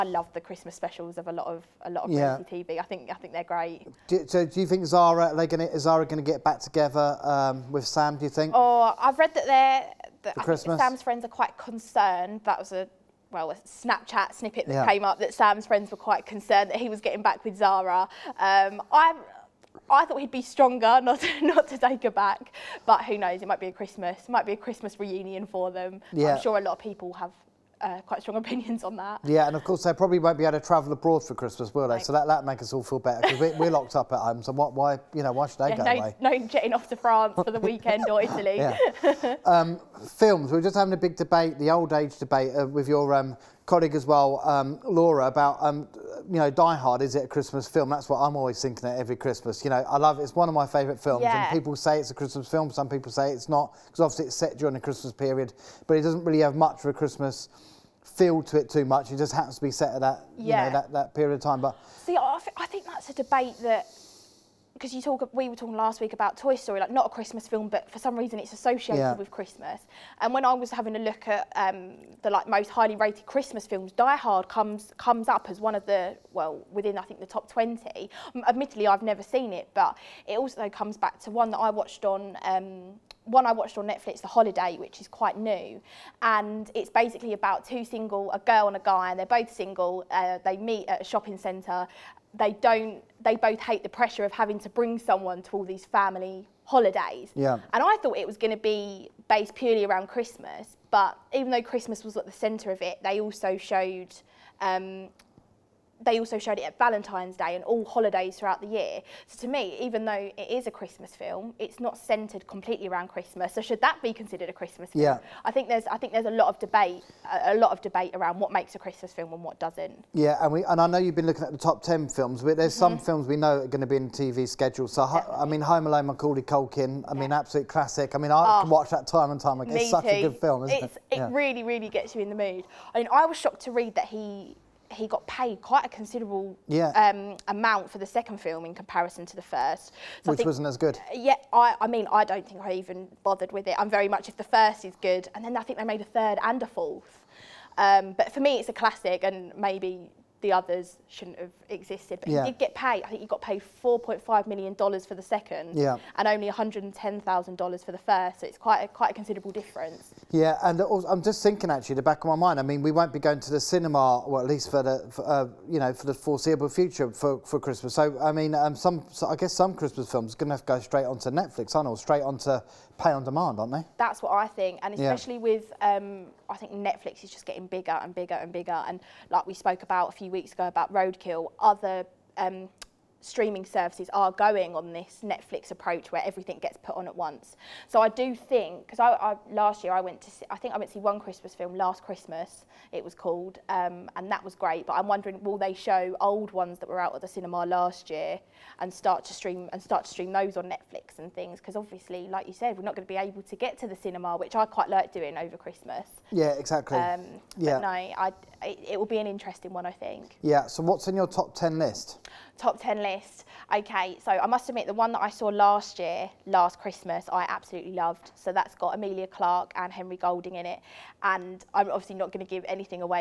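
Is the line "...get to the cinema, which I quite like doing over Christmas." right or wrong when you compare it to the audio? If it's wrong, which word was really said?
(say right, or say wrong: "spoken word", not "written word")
right.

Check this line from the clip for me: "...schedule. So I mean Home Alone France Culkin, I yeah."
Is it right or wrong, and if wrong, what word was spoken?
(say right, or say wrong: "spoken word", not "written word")
wrong: "Macaulay", not "France".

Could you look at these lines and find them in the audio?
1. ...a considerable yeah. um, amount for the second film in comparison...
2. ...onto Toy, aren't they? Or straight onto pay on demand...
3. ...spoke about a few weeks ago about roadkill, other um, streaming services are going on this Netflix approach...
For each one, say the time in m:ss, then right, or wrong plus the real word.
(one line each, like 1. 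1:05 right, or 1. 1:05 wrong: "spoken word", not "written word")
1. 2:15 right
2. 2:51 wrong: "Netflix", not "Toy"
3. 2:59 right.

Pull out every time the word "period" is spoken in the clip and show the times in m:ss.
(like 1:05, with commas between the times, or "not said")
0:55, 1:01.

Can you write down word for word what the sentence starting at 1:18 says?
admittedly, I've never seen it, but it also comes back to one that I watched on.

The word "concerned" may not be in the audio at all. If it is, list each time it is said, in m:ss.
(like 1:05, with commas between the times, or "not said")
0:11, 0:16.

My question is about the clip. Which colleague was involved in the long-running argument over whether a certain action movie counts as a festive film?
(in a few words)
Laura.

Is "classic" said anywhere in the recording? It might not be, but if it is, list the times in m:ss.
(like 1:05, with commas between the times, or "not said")
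2:07, 2:28.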